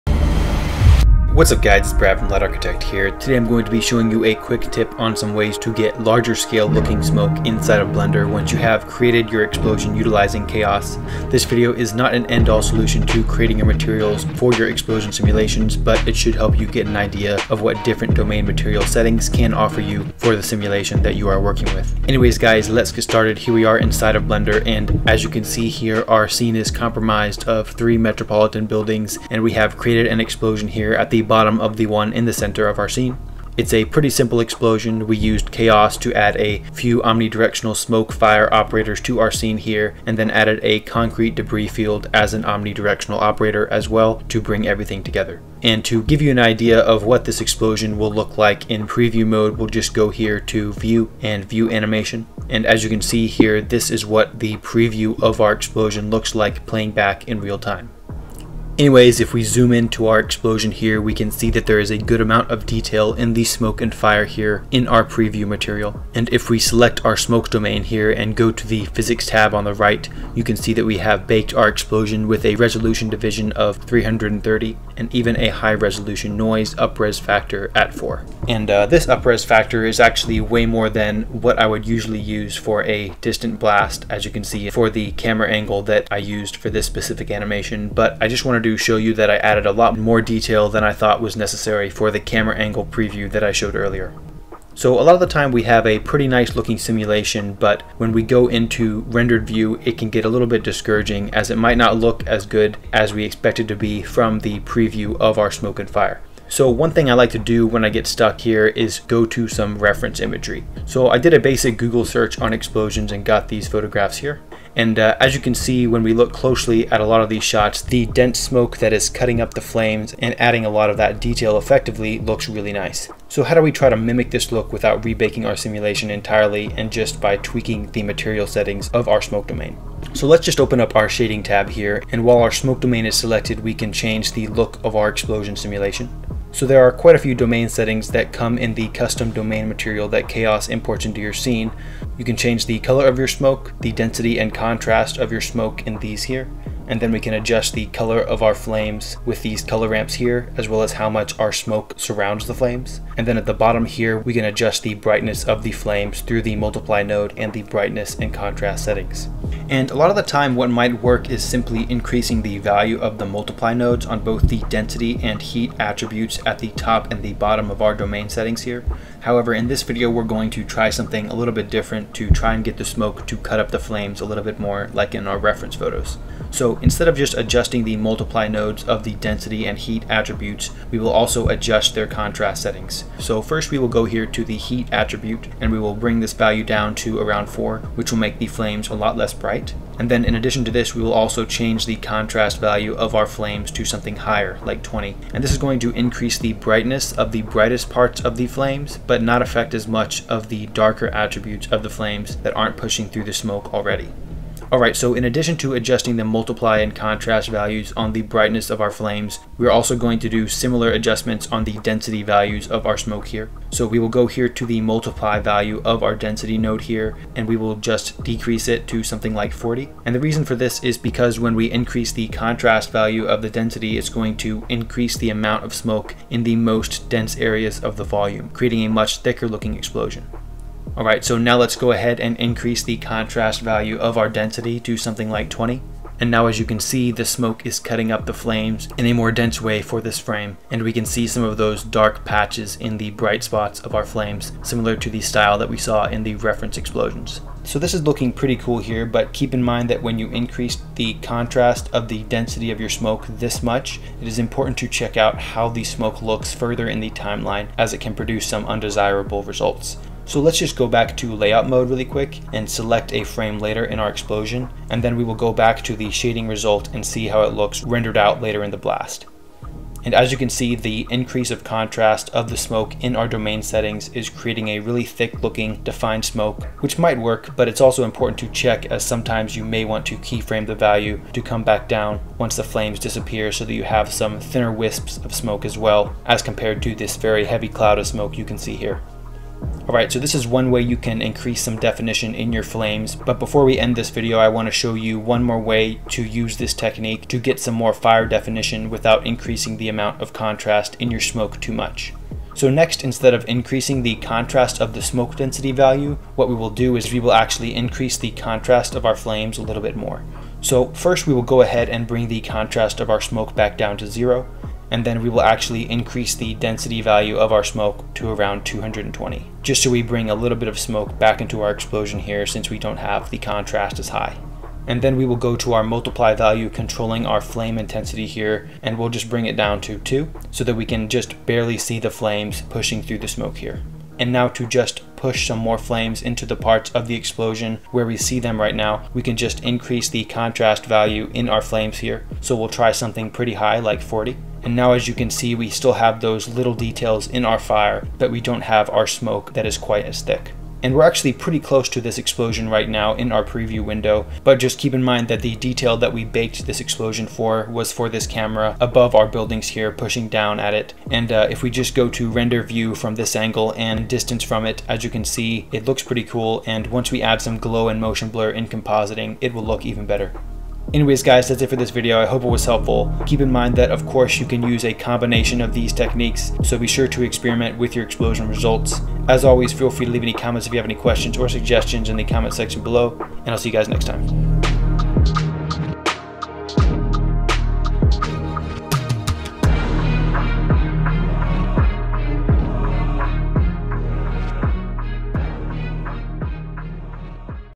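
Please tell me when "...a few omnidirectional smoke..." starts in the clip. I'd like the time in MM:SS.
00:36.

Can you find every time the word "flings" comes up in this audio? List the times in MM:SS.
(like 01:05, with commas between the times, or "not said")
not said.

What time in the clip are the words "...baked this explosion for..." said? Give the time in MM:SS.
05:56.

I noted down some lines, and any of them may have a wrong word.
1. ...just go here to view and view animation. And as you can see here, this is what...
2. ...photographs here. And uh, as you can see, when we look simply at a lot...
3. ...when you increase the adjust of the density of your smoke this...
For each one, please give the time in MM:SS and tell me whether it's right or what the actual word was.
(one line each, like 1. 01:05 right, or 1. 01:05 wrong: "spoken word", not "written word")
1. 00:49 right
2. 01:53 wrong: "closely", not "simply"
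3. 04:10 wrong: "contrast", not "adjust".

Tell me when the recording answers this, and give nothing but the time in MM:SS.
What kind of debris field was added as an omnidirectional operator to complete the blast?
00:40.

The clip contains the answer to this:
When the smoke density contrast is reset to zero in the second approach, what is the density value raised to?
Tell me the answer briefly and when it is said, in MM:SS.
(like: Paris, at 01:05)
220, at 05:18.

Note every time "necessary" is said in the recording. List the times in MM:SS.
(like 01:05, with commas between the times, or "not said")
01:31.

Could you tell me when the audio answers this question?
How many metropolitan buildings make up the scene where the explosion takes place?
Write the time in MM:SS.
00:27.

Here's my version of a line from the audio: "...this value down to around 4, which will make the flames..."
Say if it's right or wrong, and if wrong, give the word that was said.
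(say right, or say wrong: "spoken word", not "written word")
right.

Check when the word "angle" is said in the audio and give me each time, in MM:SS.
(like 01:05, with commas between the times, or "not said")
01:25, 01:32, 06:03.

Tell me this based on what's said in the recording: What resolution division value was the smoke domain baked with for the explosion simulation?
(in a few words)
330.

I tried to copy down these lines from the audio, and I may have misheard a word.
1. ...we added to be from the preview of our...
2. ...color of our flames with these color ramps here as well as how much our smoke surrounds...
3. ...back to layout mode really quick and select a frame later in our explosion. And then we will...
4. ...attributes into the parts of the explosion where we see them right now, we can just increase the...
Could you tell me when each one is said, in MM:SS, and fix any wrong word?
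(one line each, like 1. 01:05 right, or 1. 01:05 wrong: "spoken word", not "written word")
1. 01:43 wrong: "expected", not "added"
2. 02:27 right
3. 04:20 right
4. 05:35 wrong: "flames", not "attributes".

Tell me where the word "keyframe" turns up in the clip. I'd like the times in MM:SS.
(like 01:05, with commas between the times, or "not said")
04:40.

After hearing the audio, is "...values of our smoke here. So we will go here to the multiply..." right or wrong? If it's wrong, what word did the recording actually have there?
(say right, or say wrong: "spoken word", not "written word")
right.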